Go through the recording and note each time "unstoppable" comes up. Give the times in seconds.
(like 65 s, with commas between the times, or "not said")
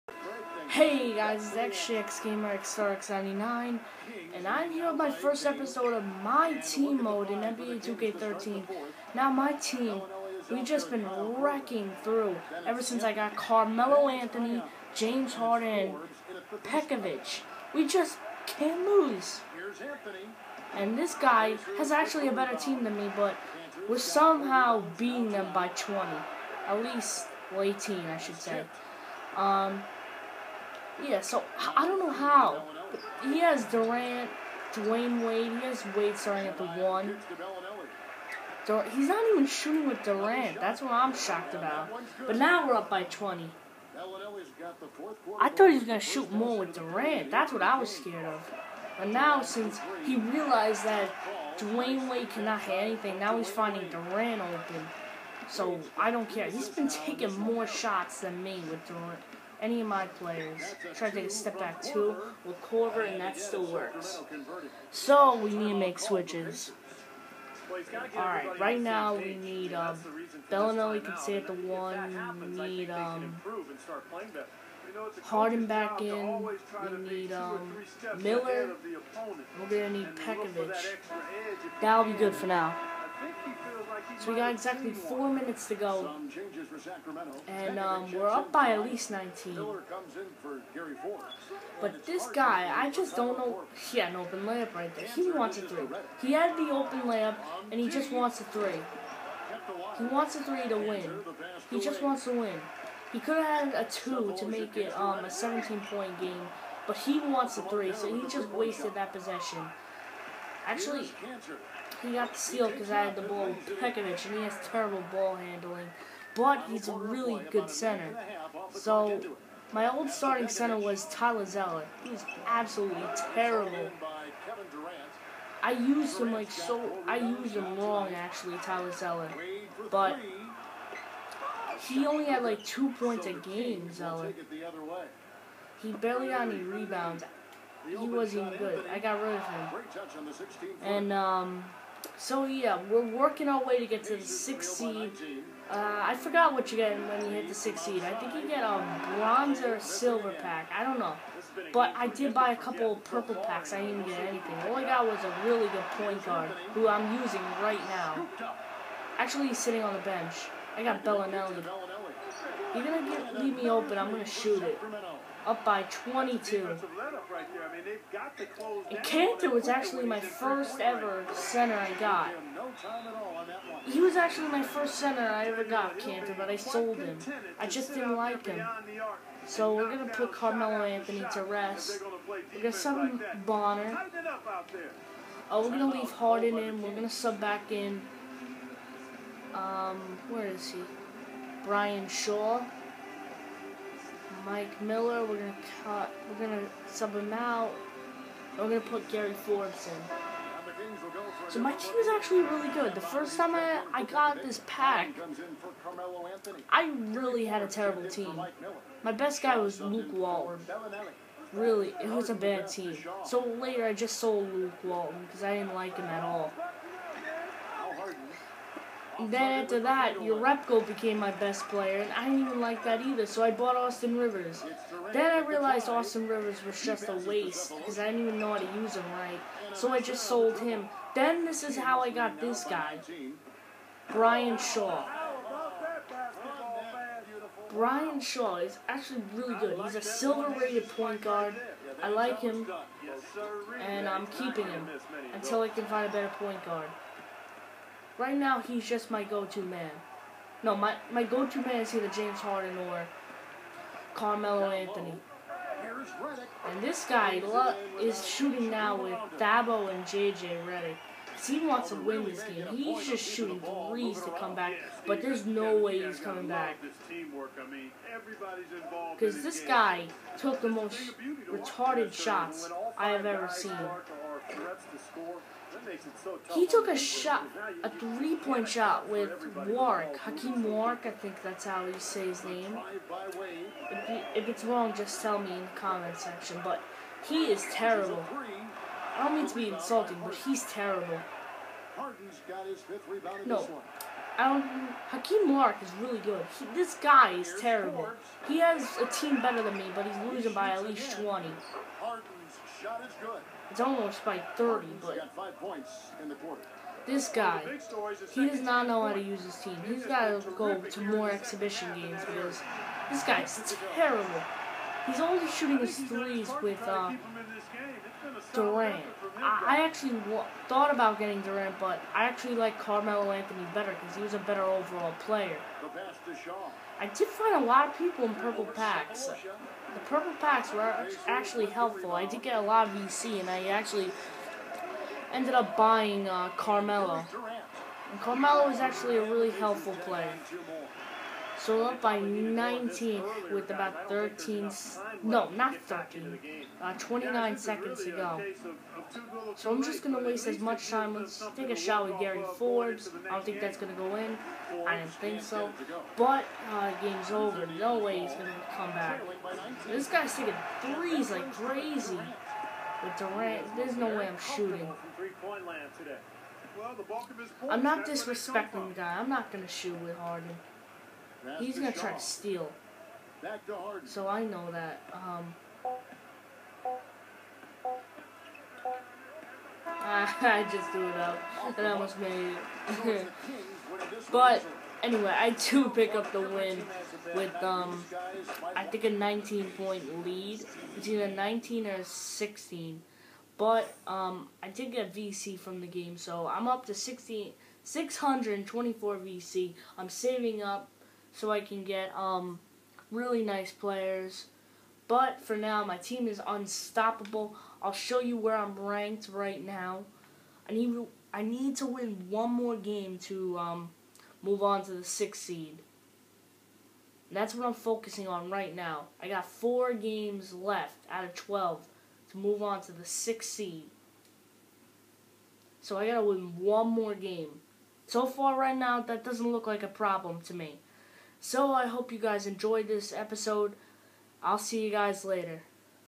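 406 s.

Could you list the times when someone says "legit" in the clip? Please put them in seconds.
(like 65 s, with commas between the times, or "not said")
not said.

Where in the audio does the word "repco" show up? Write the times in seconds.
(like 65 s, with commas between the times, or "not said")
220 s.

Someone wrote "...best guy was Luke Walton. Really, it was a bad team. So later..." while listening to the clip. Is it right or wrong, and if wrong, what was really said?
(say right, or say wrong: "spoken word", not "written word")
right.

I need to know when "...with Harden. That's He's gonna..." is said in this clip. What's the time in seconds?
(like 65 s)
370 s.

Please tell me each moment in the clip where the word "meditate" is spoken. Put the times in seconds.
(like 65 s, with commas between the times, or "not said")
not said.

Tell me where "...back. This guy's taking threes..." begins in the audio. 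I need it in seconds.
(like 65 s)
358 s.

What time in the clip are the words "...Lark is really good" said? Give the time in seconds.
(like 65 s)
295 s.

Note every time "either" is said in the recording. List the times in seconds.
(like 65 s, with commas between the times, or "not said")
223 s, 251 s.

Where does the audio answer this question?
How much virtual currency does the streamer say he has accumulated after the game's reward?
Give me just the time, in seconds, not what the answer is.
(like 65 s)
396 s.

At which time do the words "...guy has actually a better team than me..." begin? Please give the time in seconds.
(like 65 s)
21 s.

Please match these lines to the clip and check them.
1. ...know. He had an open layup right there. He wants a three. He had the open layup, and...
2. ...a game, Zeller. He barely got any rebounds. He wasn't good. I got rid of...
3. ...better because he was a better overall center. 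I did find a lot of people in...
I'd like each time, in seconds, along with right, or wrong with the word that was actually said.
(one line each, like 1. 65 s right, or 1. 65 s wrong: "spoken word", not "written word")
1. 93 s right
2. 133 s right
3. 323 s wrong: "player", not "center".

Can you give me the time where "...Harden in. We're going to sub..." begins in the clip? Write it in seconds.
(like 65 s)
186 s.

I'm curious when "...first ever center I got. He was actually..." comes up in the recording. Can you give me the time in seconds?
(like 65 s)
170 s.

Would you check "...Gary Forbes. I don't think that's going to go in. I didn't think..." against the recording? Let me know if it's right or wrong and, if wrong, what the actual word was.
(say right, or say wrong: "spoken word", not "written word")
right.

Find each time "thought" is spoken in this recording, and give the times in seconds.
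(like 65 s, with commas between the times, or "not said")
45 s, 320 s.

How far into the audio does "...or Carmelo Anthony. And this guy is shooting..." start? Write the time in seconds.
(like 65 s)
252 s.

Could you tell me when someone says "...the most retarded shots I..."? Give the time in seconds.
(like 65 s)
270 s.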